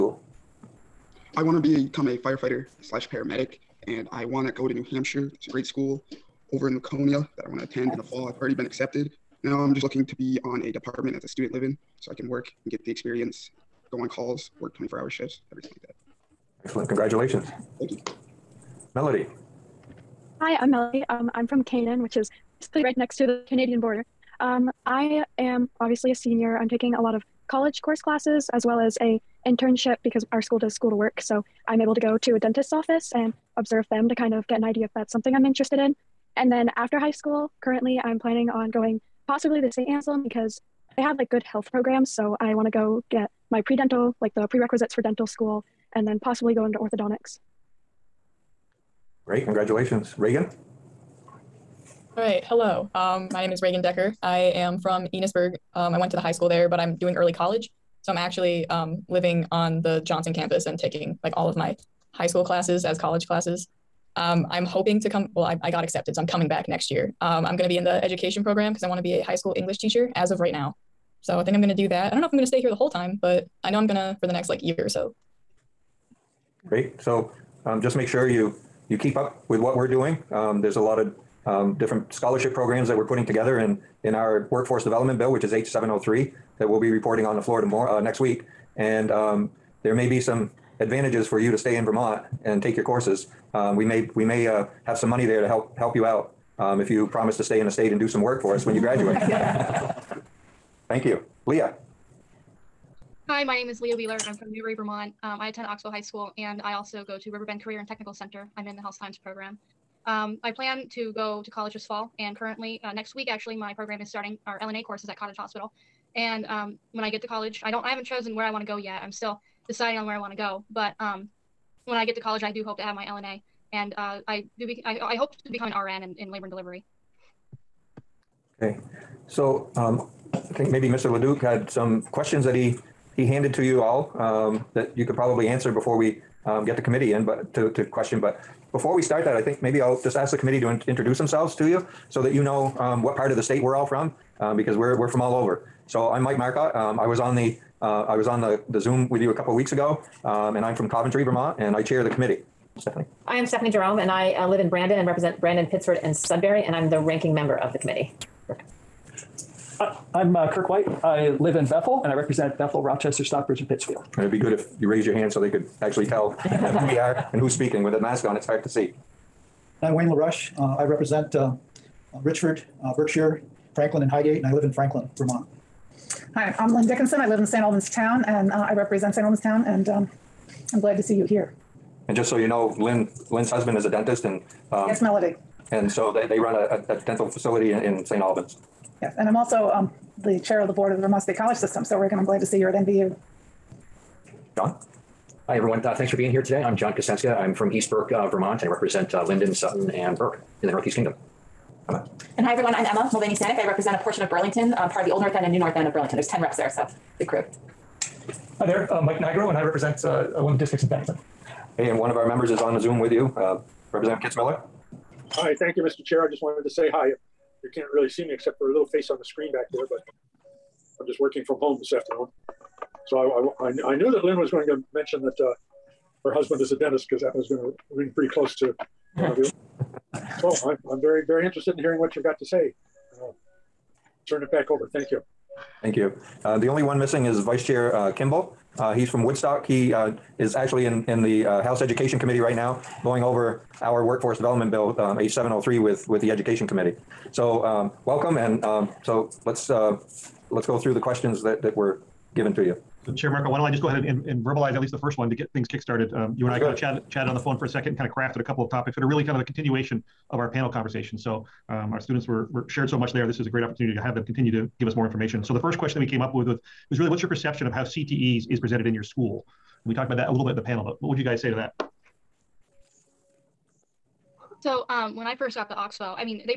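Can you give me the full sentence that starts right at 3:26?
There's 10 reps there, so the crew.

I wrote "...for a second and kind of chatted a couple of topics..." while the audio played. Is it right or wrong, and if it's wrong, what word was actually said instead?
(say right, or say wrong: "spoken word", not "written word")
wrong: "crafted", not "chatted".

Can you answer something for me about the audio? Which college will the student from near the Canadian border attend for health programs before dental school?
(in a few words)
St. Anselm.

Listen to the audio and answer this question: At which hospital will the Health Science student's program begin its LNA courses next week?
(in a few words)
Cottage Hospital.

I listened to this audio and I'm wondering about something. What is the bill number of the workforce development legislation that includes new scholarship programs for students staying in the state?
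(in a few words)
H703.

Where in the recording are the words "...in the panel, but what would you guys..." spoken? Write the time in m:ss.
4:30.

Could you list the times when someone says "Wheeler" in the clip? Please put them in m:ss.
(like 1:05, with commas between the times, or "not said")
1:43.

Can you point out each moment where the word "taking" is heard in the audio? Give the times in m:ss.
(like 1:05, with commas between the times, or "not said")
0:26, 1:00.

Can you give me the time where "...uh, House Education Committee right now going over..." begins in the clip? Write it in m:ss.
4:01.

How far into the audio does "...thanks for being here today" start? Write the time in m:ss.
3:15.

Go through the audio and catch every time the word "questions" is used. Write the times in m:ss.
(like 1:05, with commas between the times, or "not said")
2:12, 2:17, 4:10, 4:25.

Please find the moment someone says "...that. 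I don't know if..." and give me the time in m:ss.
1:11.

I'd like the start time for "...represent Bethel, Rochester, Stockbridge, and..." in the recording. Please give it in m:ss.
2:42.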